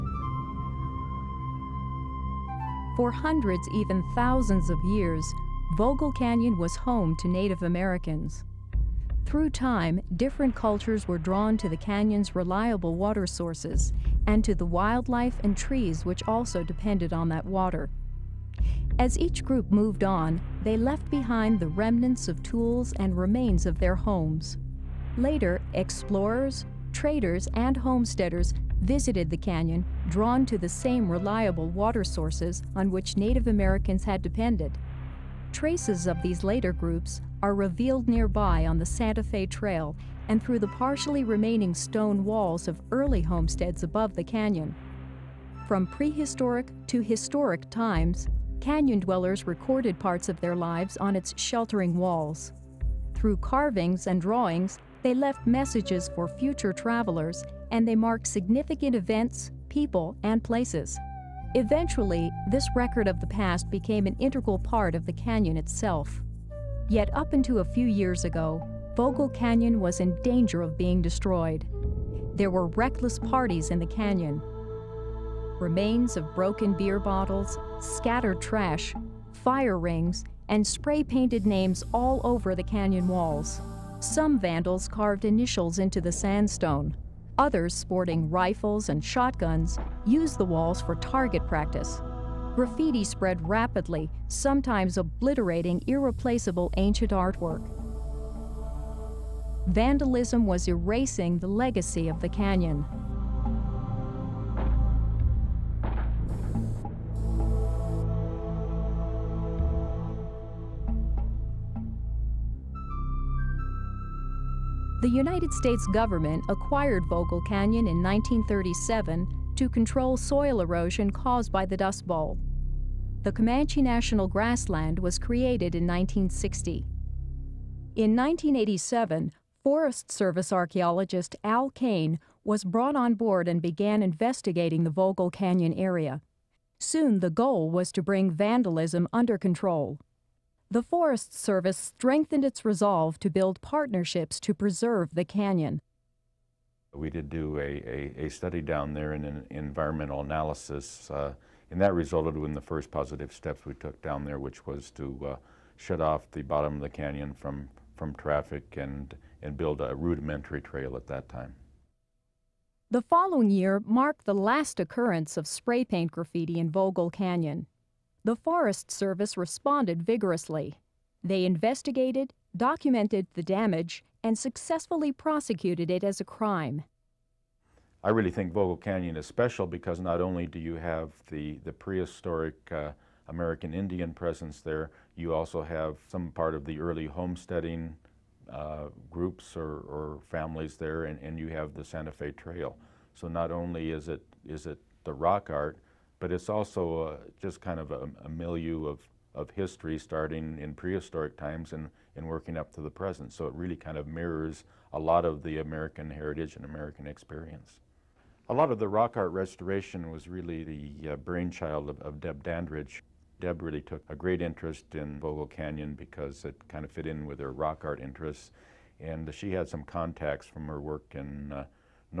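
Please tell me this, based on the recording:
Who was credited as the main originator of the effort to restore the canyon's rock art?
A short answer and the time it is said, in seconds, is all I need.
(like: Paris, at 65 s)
Deb Dandridge, at 212 s.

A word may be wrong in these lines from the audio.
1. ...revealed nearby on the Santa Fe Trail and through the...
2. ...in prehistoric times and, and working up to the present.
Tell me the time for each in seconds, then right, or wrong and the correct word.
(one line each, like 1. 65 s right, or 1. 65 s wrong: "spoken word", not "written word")
1. 37 s right
2. 200 s right.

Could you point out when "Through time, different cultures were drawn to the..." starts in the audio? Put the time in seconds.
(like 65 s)
9 s.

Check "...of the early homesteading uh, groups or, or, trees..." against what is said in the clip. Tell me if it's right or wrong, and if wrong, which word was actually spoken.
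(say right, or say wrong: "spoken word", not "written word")
wrong: "families", not "trees".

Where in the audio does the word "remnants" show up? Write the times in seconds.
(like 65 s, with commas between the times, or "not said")
21 s.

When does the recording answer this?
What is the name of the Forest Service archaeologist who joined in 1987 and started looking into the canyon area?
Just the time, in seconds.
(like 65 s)
131 s.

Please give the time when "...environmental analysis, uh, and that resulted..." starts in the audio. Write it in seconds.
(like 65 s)
149 s.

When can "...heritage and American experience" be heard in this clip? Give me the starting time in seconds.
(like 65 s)
206 s.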